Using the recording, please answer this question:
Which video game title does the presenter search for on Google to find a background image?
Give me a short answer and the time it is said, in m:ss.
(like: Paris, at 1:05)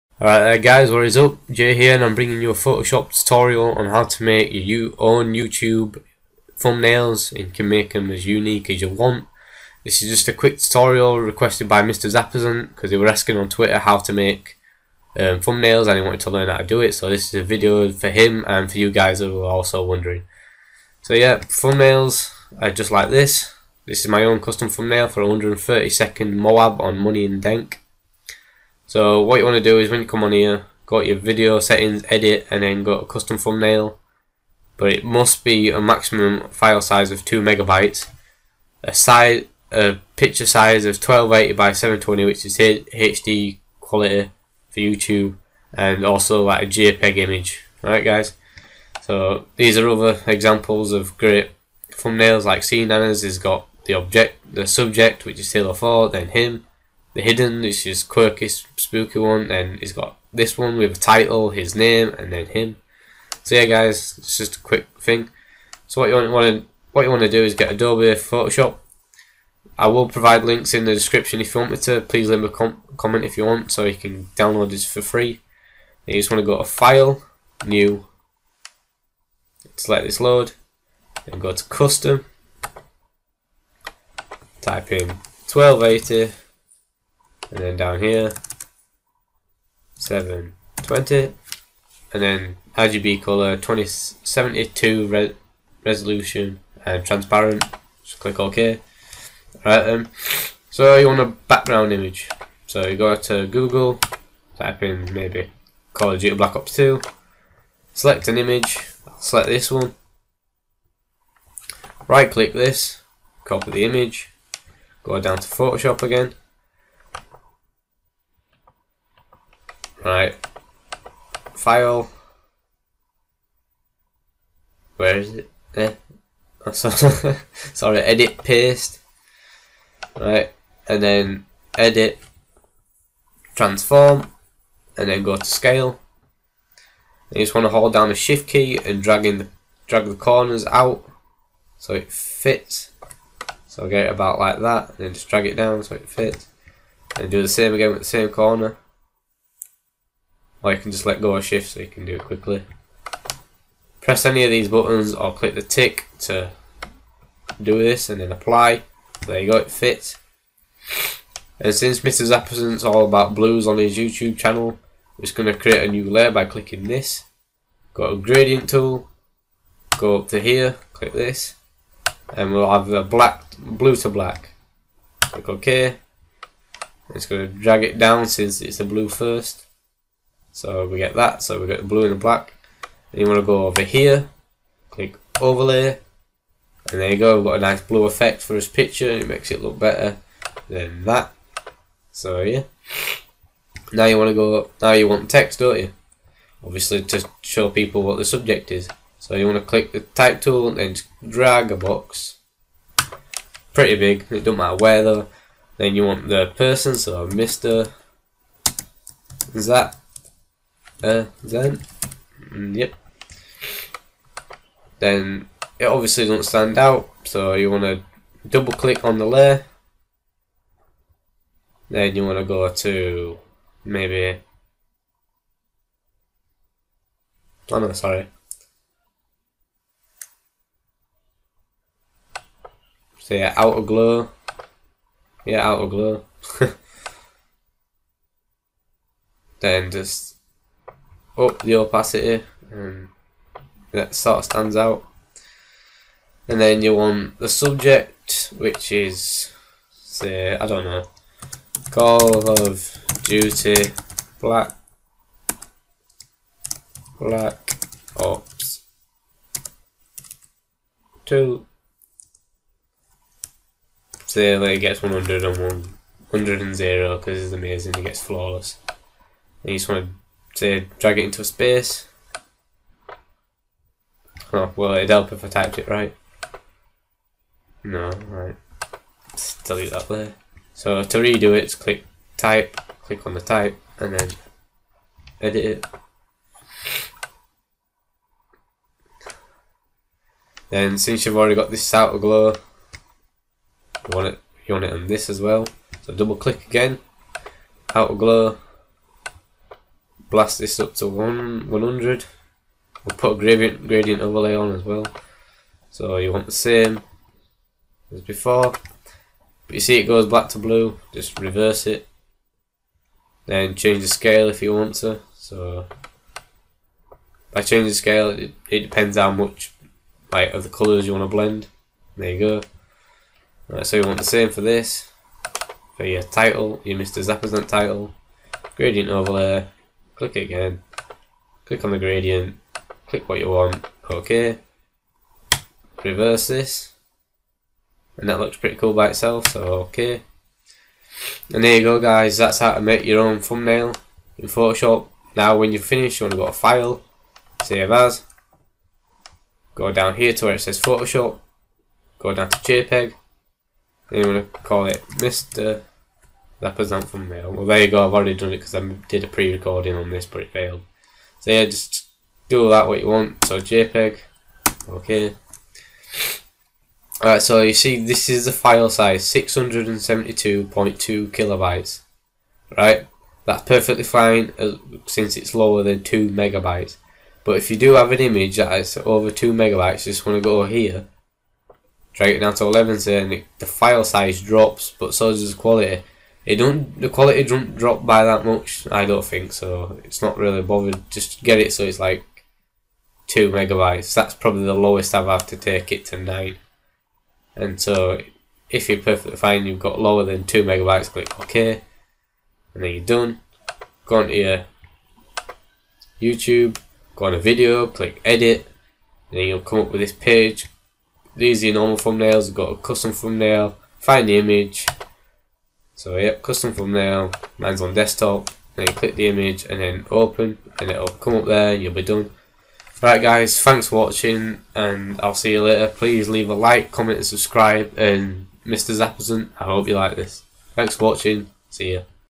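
Call of Duty Black Ops 2, at 1:45.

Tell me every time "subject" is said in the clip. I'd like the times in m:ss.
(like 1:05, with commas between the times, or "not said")
0:54, 3:18, 4:07.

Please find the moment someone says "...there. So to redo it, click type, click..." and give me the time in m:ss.
4:40.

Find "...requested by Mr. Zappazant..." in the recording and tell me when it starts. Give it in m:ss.
0:11.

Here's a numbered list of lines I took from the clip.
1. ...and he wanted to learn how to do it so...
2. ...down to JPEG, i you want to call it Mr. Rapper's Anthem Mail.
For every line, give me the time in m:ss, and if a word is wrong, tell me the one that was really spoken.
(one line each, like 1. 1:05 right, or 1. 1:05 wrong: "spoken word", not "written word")
1. 0:15 right
2. 5:52 right.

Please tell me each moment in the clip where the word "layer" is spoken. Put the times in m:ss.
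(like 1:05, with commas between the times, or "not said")
2:46, 3:39.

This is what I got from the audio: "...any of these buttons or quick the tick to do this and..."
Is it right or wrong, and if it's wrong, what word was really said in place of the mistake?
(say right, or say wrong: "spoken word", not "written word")
wrong: "click", not "quick".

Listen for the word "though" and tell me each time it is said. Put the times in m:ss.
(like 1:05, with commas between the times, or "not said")
3:25.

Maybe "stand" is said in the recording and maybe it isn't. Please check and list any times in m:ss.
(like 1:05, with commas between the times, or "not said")
3:36, 4:04.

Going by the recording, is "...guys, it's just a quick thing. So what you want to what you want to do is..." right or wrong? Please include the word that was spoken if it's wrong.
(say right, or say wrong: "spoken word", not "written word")
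right.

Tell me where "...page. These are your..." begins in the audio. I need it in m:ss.
6:50.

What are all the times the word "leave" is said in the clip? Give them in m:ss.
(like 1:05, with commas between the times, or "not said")
1:12, 7:06.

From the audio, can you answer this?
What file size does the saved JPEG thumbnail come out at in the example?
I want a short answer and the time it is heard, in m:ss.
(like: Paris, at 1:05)
672.2 kilobytes, at 6:09.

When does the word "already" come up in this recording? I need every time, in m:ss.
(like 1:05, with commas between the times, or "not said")
4:51, 5:58.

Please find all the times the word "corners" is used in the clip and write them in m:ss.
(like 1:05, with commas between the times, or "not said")
2:20, 2:28.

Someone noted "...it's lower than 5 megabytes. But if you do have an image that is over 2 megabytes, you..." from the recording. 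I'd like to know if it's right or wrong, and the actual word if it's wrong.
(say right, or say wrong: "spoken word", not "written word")
wrong: "2", not "5".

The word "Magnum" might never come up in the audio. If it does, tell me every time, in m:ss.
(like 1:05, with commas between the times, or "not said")
not said.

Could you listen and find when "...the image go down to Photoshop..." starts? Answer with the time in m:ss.
1:53.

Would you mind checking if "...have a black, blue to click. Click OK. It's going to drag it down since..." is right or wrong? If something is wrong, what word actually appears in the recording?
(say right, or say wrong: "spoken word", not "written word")
wrong: "black", not "click".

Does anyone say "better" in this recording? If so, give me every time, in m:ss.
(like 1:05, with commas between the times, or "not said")
3:09.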